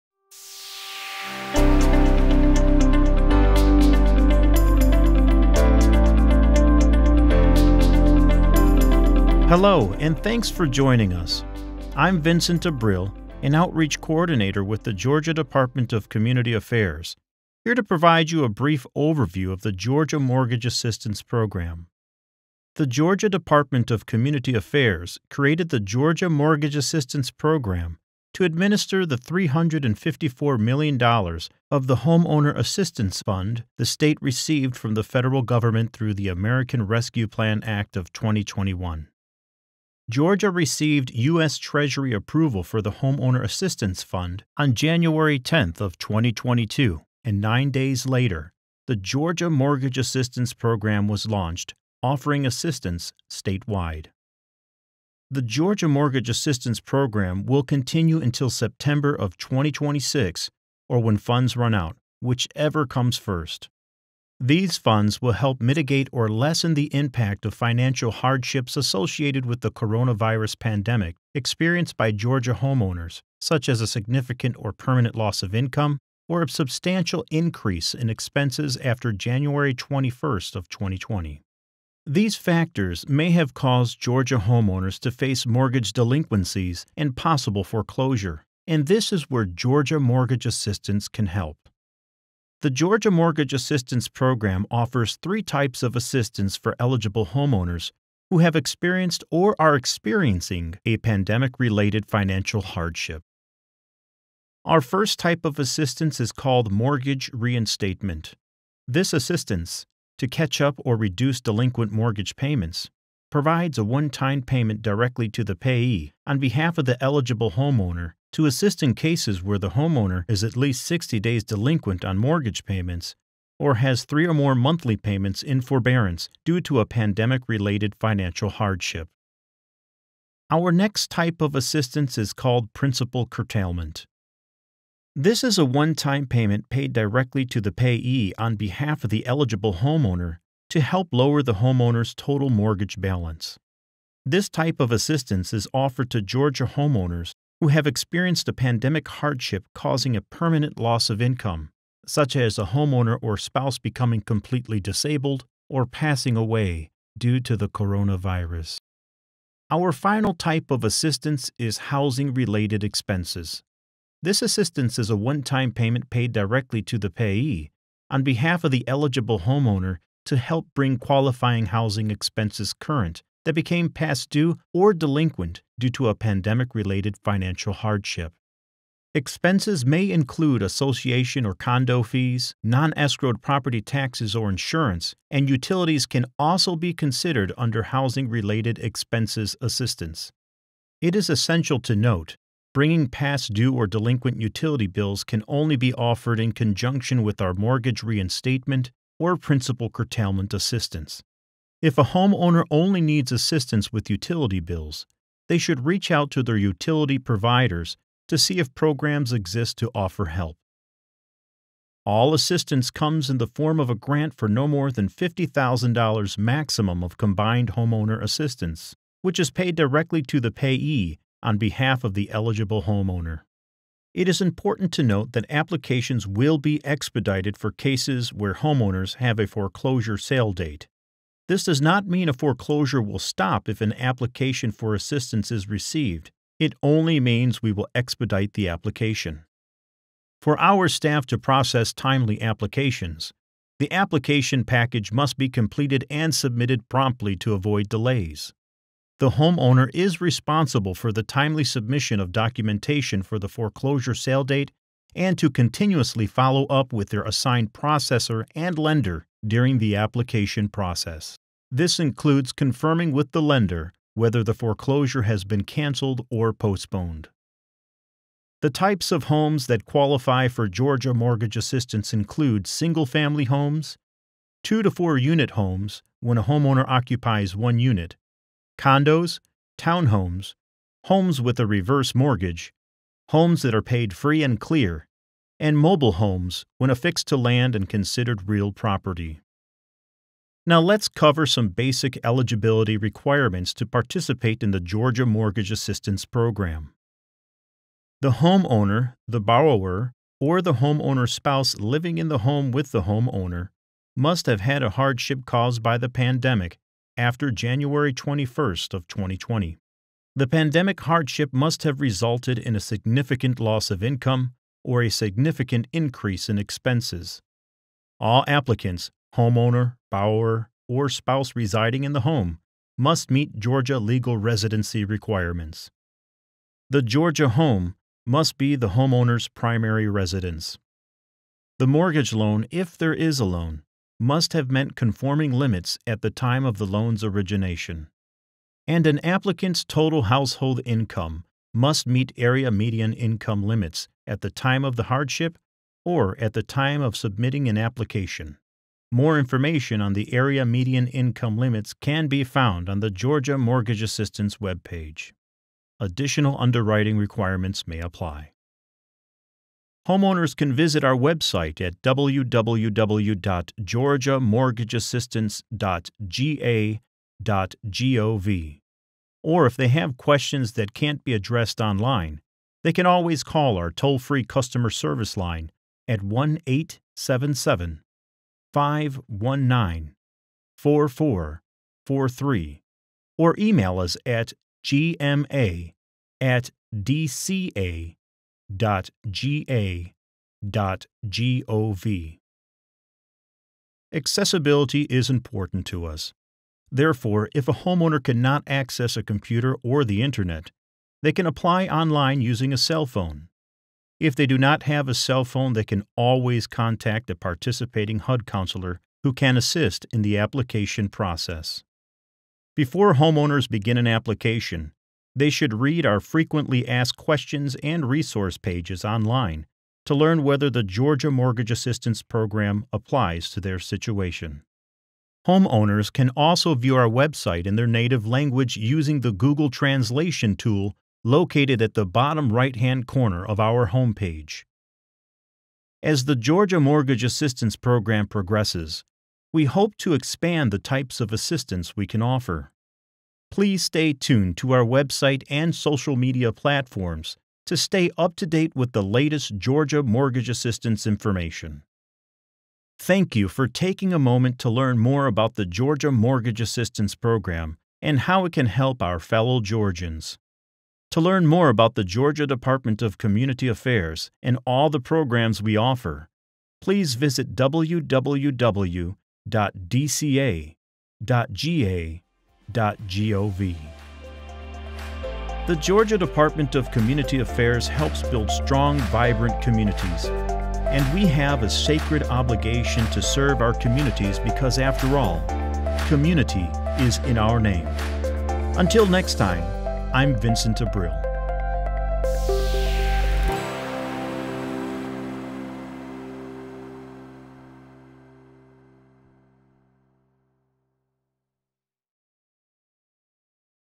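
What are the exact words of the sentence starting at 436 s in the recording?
As the Georgia Mortgage Assistance Program progresses, we hope to expand the types of assistance we can offer.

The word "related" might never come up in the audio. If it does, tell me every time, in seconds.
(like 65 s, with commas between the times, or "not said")
101 s, 127 s, 162 s, 176 s, 188 s.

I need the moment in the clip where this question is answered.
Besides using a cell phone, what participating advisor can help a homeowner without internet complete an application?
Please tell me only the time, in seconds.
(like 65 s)
408 s.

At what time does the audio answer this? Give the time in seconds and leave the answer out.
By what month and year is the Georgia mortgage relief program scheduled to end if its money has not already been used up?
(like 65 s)
58 s.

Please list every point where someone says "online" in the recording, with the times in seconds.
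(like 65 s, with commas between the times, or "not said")
371 s, 401 s, 419 s.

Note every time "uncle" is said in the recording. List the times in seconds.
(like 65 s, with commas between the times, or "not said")
not said.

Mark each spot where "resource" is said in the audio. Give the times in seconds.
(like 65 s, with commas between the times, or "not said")
418 s.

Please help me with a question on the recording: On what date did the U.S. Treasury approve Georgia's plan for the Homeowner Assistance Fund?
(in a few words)
January 10, 2022.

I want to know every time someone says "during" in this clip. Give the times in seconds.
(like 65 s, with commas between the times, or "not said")
259 s.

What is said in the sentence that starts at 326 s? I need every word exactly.
The Georgia home must be the homeowner's primary residence.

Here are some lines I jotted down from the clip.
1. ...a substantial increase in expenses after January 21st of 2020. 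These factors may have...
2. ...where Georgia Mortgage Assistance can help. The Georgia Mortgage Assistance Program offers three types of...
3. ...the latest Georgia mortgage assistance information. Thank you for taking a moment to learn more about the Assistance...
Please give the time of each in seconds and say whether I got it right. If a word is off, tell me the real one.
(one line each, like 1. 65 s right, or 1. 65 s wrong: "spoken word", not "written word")
1. 76 s right
2. 89 s right
3. 448 s wrong: "Georgia", not "Assistance".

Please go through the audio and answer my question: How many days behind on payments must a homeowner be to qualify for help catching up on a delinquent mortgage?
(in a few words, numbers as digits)
60 days.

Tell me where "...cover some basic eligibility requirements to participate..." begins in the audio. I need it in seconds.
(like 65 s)
291 s.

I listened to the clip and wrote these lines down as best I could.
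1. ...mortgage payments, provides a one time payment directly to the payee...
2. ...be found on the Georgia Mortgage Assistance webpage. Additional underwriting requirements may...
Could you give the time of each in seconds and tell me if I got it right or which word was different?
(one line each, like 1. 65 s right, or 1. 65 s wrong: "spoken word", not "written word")
1. 111 s right
2. 352 s right.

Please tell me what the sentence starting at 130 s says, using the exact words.
Our next type of assistance is called principal curtailment.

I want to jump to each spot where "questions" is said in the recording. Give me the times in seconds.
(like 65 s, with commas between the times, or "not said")
370 s, 417 s.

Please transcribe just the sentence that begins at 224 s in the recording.
It is important to note that applications will be expedited for cases where homeowners have a foreclosure sale date.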